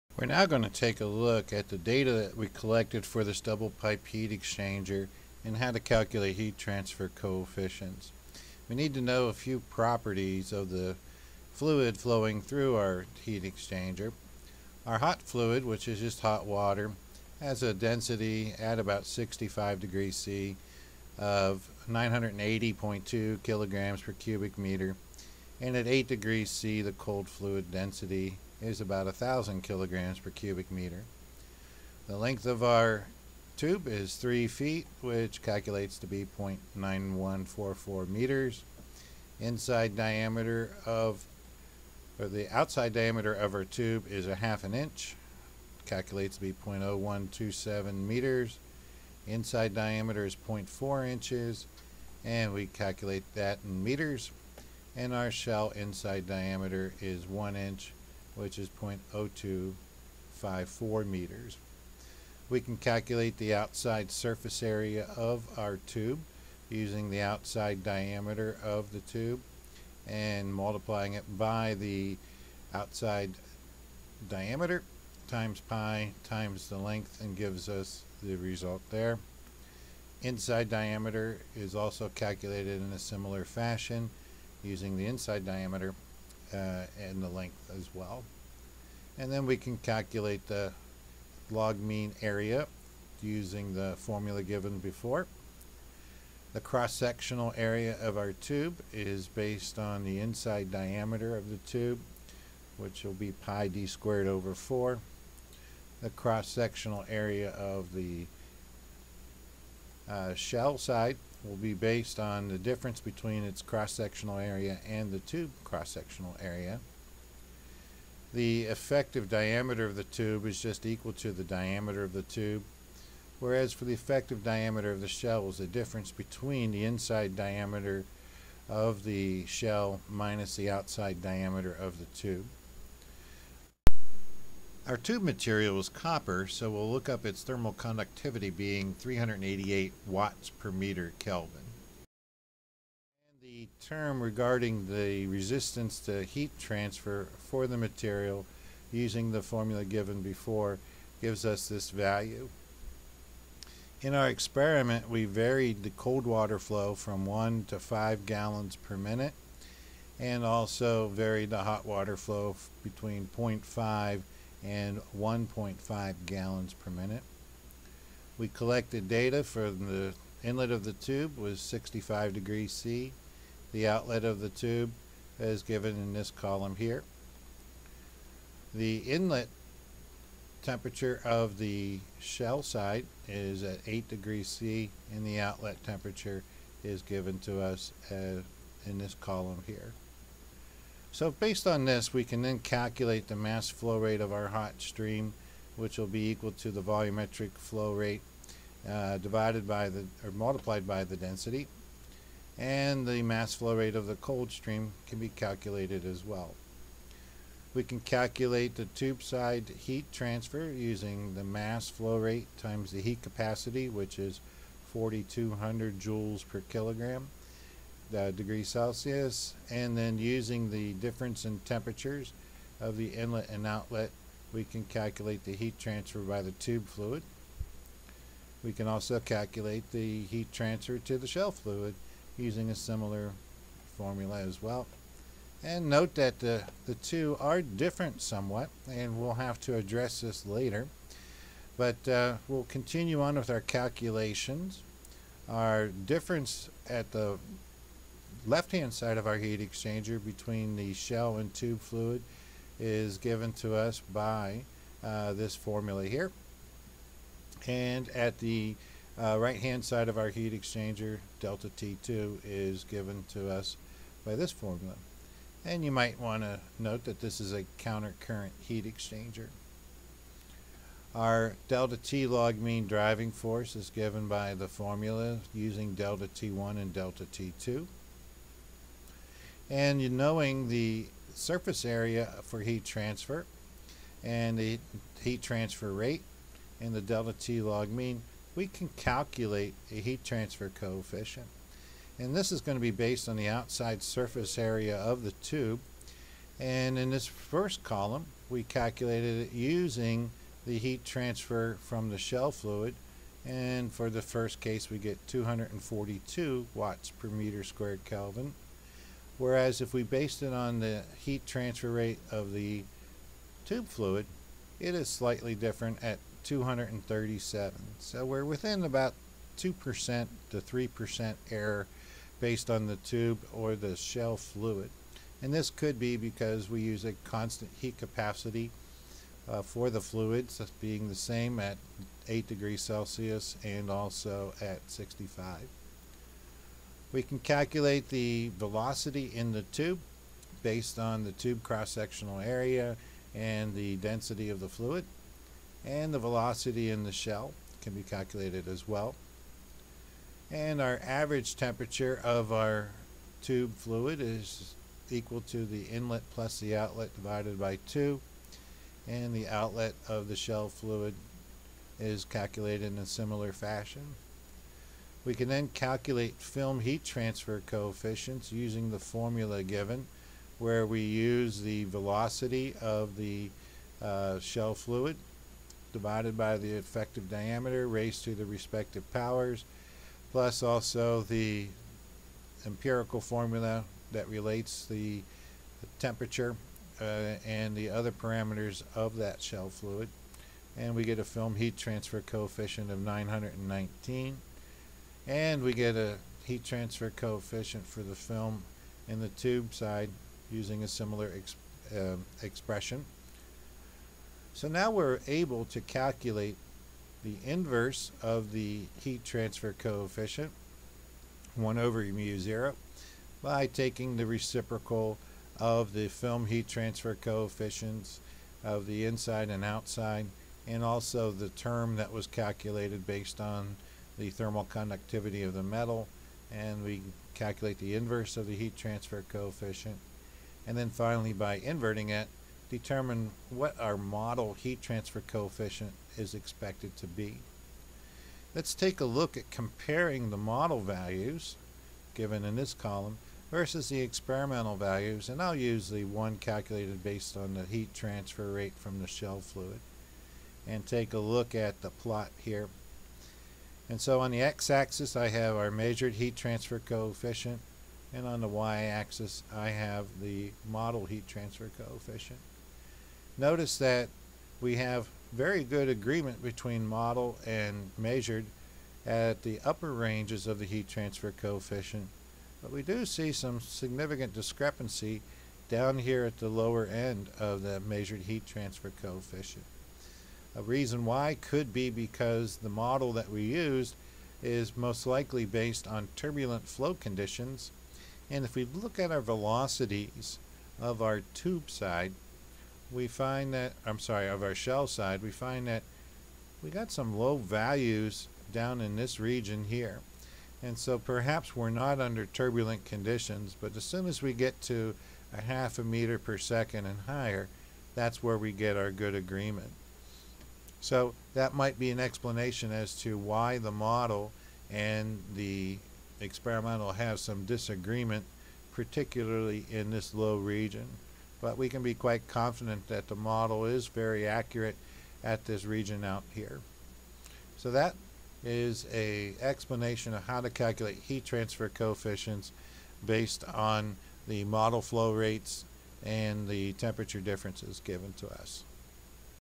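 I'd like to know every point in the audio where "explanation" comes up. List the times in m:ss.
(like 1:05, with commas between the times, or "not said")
8:31, 8:49.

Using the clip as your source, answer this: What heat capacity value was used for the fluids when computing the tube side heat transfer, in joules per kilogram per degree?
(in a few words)
4200.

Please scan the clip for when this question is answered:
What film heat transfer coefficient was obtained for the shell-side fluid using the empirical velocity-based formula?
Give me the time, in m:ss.
6:32.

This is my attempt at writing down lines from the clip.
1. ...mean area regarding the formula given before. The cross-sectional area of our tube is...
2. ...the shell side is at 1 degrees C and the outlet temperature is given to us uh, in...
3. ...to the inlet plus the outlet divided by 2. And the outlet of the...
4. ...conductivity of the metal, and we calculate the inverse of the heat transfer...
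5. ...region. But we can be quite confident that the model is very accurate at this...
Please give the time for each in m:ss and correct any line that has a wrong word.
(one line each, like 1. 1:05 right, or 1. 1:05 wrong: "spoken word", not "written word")
1. 1:31 wrong: "using", not "regarding"
2. 3:01 wrong: "8", not "1"
3. 5:55 right
4. 7:04 right
5. 8:40 right.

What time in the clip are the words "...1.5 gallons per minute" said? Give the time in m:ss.
2:45.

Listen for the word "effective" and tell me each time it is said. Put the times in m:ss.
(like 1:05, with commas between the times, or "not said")
1:58, 2:03, 6:16.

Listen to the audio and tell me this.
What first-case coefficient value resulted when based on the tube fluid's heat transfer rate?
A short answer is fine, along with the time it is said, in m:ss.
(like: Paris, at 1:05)
237, at 5:16.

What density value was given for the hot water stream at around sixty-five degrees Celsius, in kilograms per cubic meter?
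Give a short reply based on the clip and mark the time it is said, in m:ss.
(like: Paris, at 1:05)
980.2, at 0:21.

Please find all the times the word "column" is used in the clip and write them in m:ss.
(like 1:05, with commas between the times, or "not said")
2:56, 3:09, 4:57, 7:22.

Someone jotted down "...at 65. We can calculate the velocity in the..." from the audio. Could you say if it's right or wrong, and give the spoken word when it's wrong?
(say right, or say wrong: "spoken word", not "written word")
right.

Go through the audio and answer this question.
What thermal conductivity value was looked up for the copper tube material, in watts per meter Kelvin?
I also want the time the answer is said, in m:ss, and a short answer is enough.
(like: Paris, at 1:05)
388, at 2:18.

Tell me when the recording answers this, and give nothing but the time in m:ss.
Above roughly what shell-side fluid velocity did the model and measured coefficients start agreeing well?
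8:25.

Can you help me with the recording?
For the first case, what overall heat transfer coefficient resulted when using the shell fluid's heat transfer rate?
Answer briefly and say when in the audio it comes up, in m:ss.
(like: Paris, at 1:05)
242, at 5:05.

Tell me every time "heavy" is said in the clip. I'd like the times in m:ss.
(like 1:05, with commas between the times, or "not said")
not said.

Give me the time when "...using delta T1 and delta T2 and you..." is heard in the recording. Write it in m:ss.
4:35.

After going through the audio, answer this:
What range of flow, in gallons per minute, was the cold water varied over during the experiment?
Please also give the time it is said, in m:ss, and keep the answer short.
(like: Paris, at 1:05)
1 to 5 gallons per minute, at 2:37.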